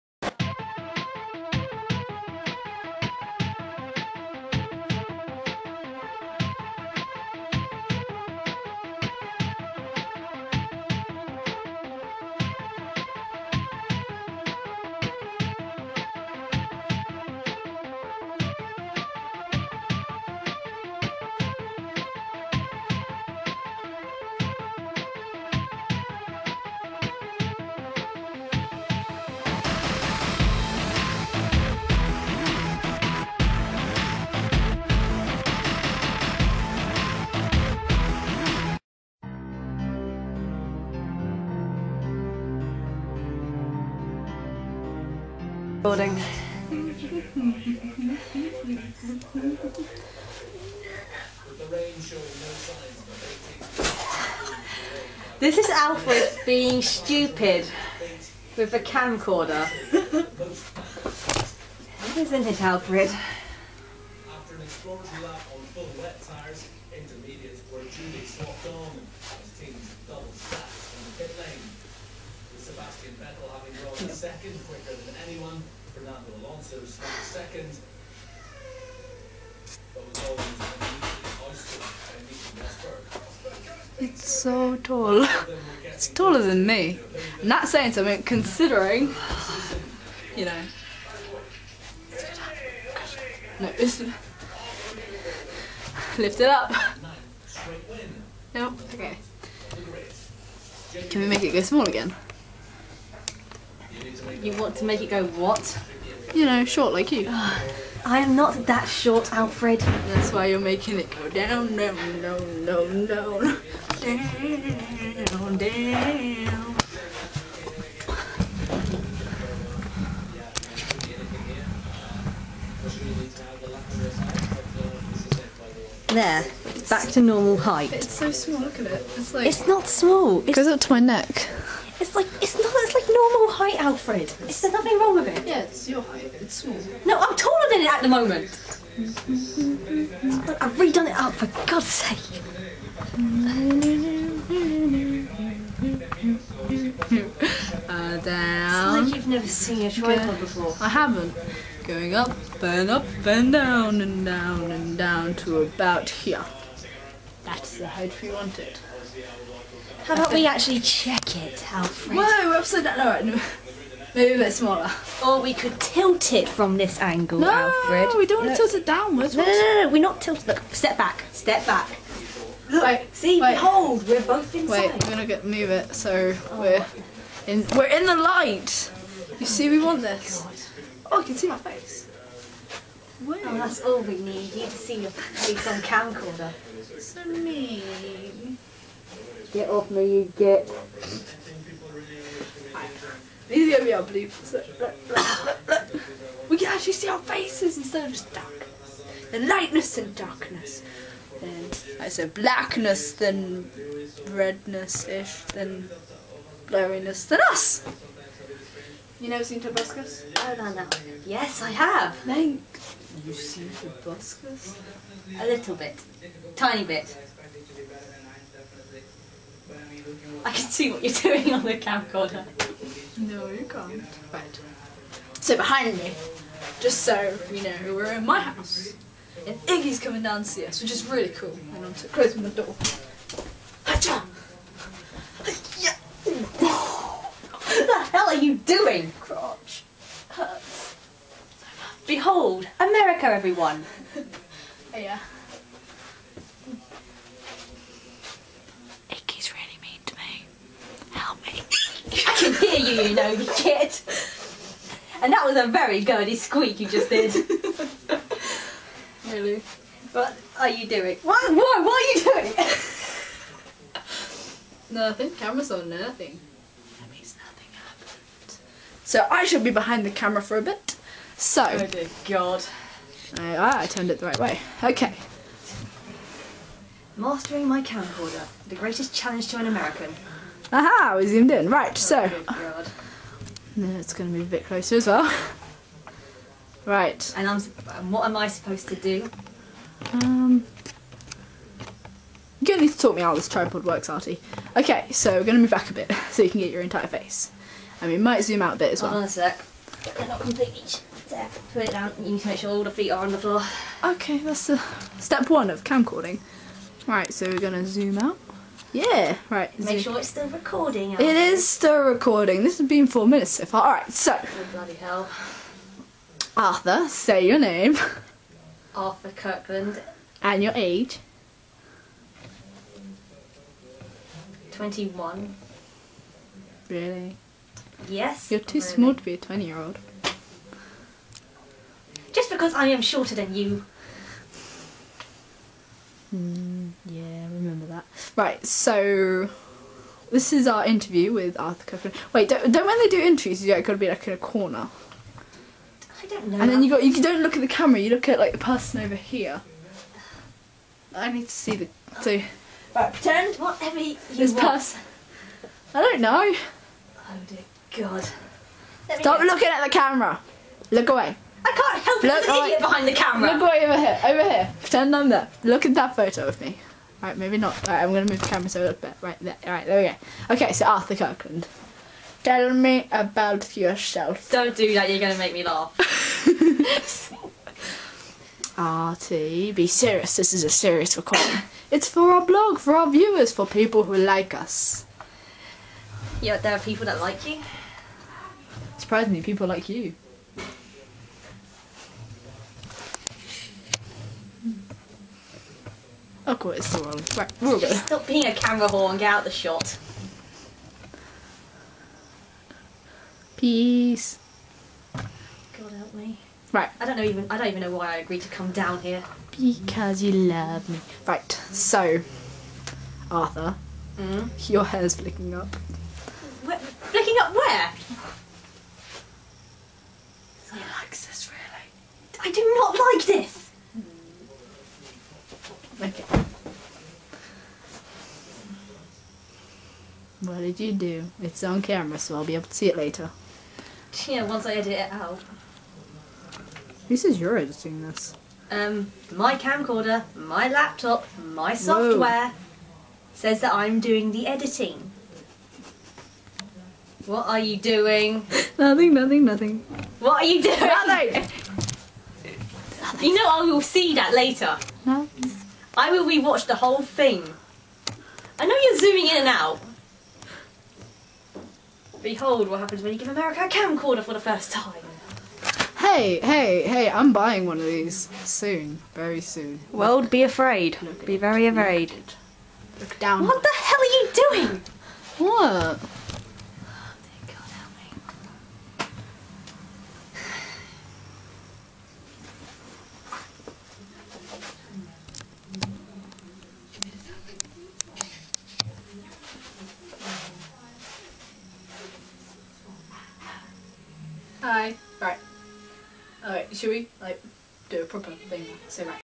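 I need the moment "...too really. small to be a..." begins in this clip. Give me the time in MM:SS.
05:28.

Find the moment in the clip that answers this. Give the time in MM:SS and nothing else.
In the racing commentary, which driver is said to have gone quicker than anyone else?
01:12.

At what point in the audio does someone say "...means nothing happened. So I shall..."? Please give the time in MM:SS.
04:27.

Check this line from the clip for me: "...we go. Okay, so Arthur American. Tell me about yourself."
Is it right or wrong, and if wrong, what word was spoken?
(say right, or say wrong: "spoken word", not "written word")
wrong: "Kirkland", not "American".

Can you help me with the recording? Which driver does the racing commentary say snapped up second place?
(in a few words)
Fernando Alonso.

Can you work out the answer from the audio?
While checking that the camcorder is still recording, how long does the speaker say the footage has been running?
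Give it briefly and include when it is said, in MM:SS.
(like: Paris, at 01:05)
4 minutes, at 05:13.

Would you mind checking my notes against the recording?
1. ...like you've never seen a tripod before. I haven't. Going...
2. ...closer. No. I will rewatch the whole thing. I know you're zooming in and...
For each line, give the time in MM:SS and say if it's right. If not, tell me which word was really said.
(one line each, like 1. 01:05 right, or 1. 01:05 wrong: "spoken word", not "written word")
1. 02:29 right
2. 07:34 wrong: "later", not "closer".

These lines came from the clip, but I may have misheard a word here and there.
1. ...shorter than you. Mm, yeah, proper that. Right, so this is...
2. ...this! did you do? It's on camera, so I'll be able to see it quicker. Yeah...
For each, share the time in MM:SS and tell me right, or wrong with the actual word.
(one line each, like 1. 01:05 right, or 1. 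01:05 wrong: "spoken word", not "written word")
1. 05:33 wrong: "remember", not "proper"
2. 07:03 wrong: "later", not "quicker".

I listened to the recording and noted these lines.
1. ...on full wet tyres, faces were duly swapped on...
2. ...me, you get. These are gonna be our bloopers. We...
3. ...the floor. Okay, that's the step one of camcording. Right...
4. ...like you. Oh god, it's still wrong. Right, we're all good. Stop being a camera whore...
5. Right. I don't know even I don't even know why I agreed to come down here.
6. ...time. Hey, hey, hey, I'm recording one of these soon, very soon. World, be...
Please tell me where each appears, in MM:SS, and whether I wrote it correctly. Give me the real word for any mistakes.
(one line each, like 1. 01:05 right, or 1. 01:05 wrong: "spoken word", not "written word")
1. 01:05 wrong: "intermediates", not "faces"
2. 03:09 right
3. 05:03 right
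4. 06:29 right
5. 06:46 right
6. 07:44 wrong: "buying", not "recording".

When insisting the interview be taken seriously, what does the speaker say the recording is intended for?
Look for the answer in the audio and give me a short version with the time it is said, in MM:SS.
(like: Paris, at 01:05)
our blog, at 06:22.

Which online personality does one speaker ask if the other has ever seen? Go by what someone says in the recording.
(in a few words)
Tobuscus.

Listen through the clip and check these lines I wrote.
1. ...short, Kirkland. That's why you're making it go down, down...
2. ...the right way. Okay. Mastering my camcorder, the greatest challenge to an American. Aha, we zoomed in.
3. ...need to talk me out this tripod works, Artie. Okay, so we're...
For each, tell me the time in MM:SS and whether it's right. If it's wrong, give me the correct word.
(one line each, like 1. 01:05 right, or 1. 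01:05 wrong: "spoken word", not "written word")
1. 01:48 wrong: "Alfred", not "Kirkland"
2. 04:34 right
3. 04:52 right.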